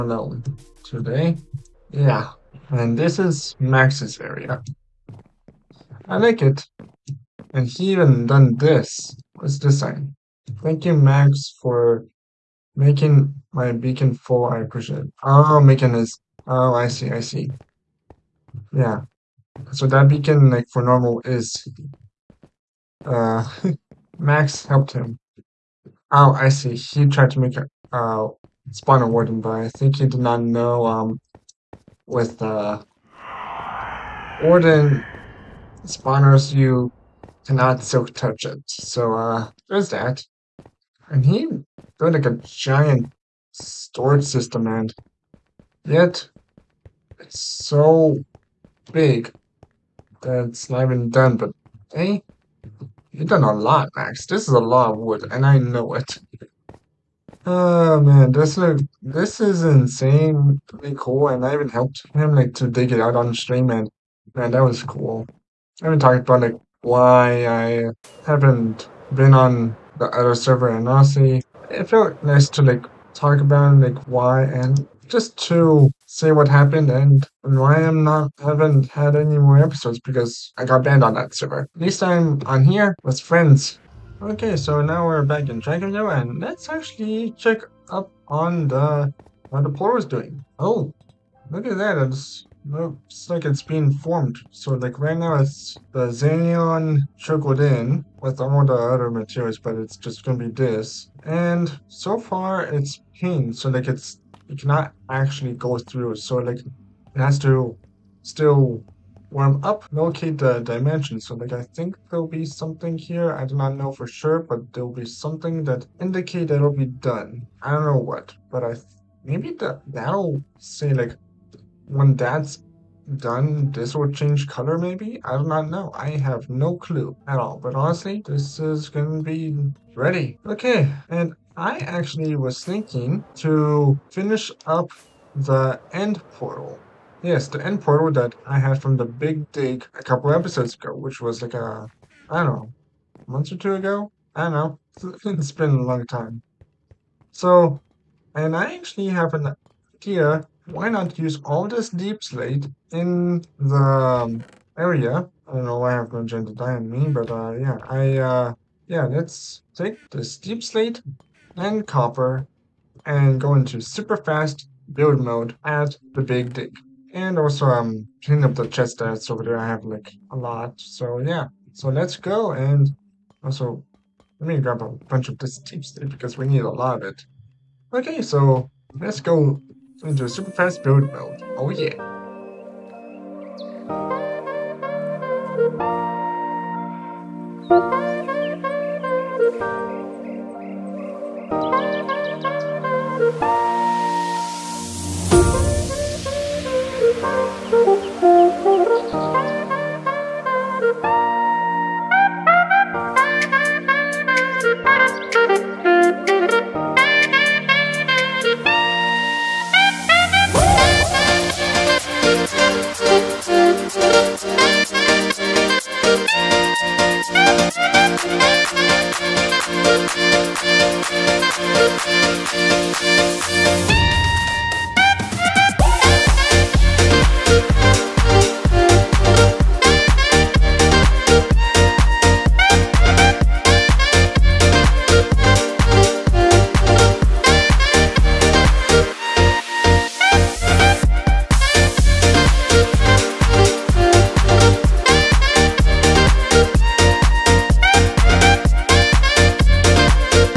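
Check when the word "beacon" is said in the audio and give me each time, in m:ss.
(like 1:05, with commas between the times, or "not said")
0:13, 0:20.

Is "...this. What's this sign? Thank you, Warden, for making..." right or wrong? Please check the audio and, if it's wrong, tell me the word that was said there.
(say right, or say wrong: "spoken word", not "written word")
wrong: "Max", not "Warden".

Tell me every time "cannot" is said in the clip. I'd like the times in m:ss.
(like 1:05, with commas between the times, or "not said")
0:37, 1:44.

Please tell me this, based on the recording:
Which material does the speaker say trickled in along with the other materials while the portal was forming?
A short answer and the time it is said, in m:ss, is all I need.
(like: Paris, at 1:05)
Xenion, at 1:36.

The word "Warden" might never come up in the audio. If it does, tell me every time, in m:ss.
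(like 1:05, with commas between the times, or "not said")
0:29, 0:34.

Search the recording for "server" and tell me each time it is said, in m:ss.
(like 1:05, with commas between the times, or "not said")
1:10, 1:21.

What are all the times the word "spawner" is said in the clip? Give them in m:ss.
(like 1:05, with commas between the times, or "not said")
0:28, 0:35.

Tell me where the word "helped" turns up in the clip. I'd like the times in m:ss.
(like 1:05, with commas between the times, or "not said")
0:24, 1:01.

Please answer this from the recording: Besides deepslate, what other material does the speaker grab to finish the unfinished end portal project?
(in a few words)
Copper.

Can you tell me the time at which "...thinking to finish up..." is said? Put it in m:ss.
2:12.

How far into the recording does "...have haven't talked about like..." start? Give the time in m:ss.
1:05.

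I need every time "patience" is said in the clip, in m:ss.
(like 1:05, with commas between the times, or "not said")
not said.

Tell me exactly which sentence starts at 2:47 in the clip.
And also I'm cleaning up the chest that's over there.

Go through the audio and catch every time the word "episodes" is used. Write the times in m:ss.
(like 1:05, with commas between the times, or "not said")
1:19, 2:20.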